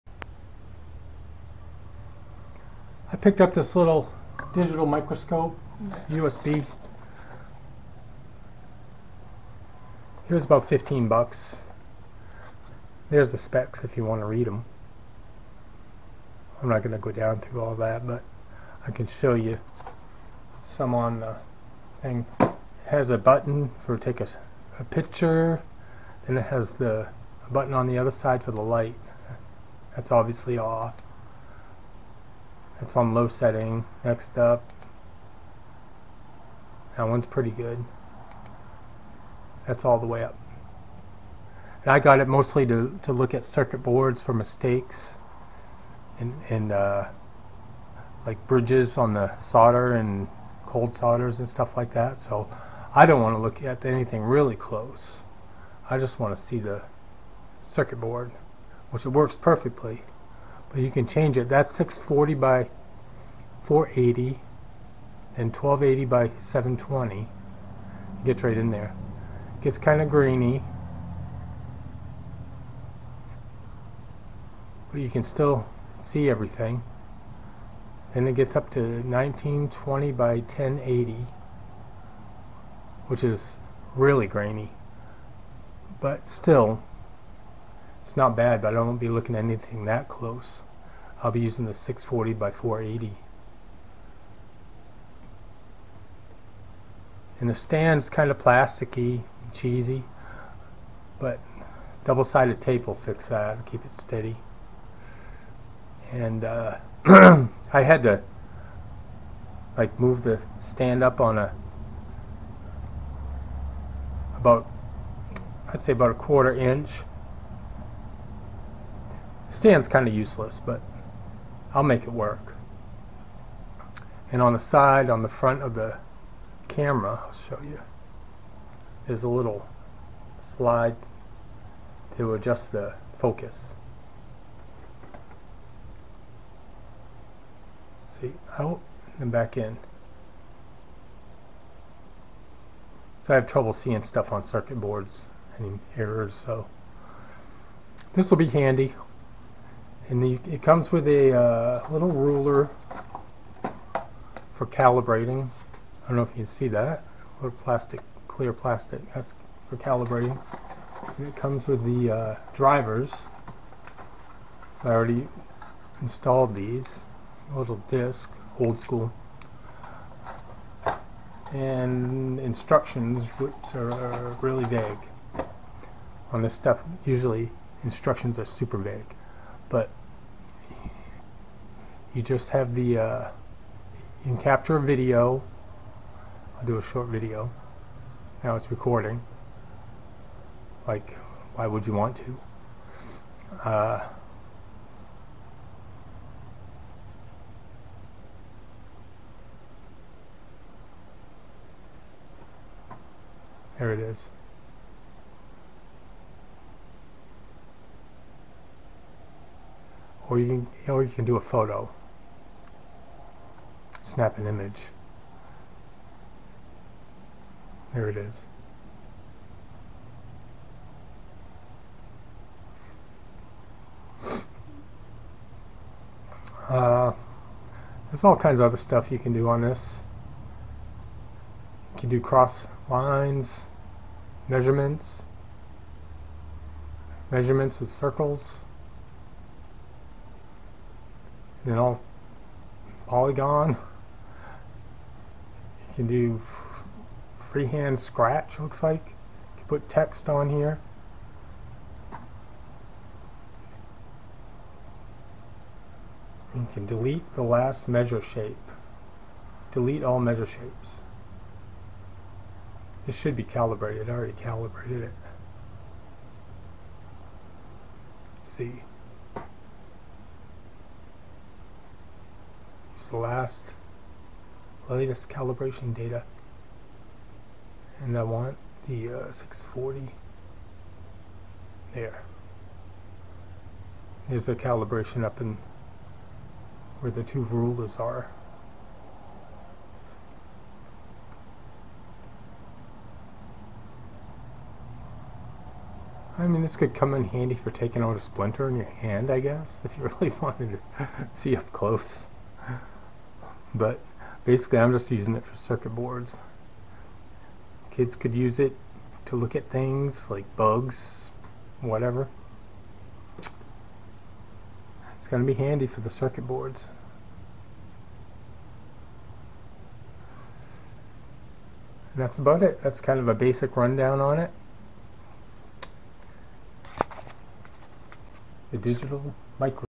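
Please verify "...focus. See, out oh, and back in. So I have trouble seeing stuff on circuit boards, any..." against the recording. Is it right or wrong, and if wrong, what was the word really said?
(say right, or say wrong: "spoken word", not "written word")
right.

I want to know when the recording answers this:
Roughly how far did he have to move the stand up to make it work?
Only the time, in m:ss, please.
1:56.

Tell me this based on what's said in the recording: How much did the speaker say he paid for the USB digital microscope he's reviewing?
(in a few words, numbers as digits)
$15.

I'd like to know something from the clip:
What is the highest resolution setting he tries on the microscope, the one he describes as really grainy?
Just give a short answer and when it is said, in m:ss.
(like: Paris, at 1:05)
1920 by 1080, at 1:18.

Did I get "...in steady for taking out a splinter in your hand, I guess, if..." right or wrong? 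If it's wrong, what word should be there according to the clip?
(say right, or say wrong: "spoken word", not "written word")
wrong: "handy", not "steady".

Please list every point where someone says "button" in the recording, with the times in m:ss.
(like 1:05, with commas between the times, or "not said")
0:23, 0:27.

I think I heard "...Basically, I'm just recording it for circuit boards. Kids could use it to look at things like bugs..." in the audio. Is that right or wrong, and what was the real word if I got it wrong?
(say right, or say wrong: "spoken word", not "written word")
wrong: "using", not "recording".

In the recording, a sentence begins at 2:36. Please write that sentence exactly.
I don't know if you can see that.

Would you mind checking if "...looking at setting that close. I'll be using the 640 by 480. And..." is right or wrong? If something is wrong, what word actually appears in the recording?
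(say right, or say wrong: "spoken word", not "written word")
wrong: "anything", not "setting".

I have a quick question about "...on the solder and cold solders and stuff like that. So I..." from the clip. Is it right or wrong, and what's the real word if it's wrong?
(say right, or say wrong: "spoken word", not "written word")
right.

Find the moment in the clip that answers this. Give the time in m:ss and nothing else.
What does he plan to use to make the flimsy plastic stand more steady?
1:42.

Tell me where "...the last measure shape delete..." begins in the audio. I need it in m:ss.
4:17.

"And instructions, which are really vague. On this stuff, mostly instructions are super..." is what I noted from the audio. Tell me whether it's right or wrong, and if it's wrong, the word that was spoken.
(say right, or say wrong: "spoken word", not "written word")
wrong: "usually", not "mostly".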